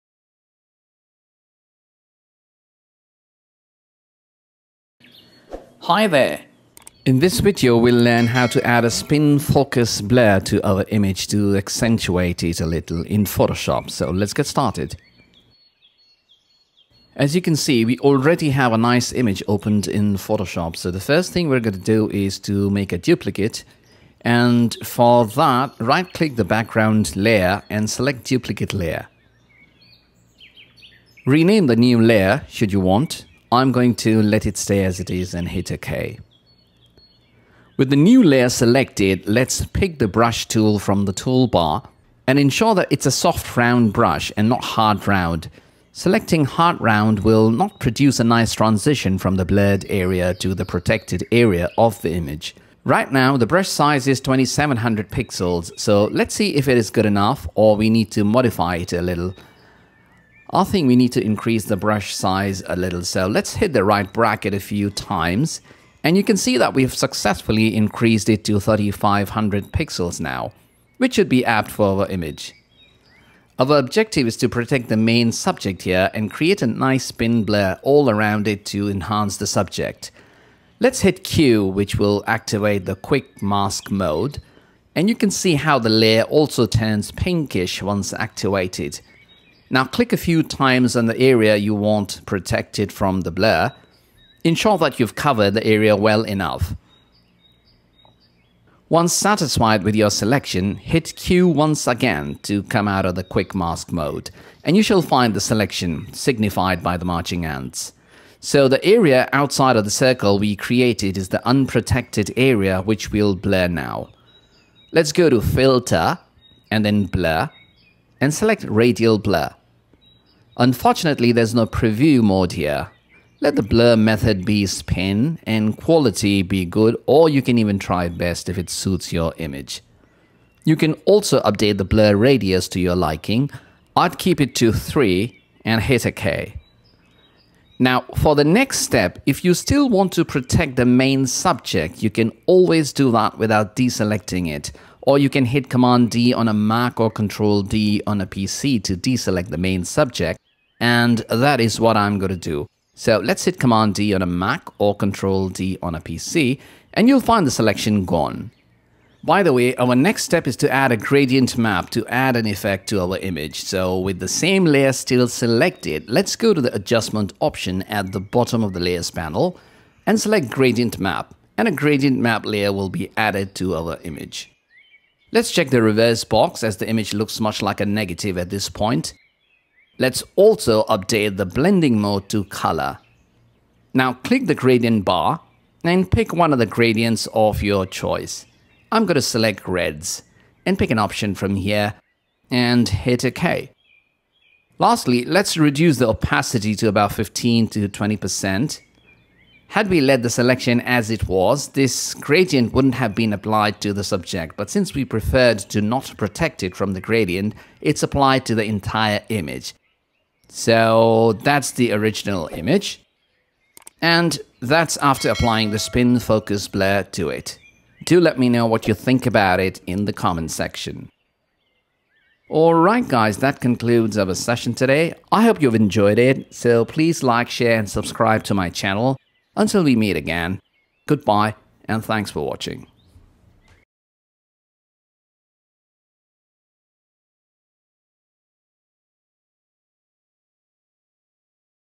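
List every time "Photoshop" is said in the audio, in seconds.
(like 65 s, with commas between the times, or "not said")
13 s, 20 s.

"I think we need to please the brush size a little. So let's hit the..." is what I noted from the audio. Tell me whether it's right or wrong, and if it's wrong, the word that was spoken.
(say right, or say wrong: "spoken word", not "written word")
wrong: "increase", not "please".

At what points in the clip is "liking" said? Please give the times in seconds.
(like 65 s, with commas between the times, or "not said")
132 s.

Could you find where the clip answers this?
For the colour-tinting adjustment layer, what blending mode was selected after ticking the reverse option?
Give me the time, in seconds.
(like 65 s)
182 s.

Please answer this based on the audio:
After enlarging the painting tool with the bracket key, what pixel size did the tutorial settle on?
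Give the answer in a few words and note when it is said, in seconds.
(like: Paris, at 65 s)
3500, at 68 s.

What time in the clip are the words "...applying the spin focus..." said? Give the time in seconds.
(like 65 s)
215 s.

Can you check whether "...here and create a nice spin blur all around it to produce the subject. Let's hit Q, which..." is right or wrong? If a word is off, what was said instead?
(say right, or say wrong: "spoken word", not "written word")
wrong: "enhance", not "produce".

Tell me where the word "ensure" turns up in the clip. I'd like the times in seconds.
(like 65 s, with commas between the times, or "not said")
42 s, 94 s.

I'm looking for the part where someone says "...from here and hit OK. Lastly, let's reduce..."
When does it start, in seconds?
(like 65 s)
191 s.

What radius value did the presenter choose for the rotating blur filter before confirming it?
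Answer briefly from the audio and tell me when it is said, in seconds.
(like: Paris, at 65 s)
3, at 134 s.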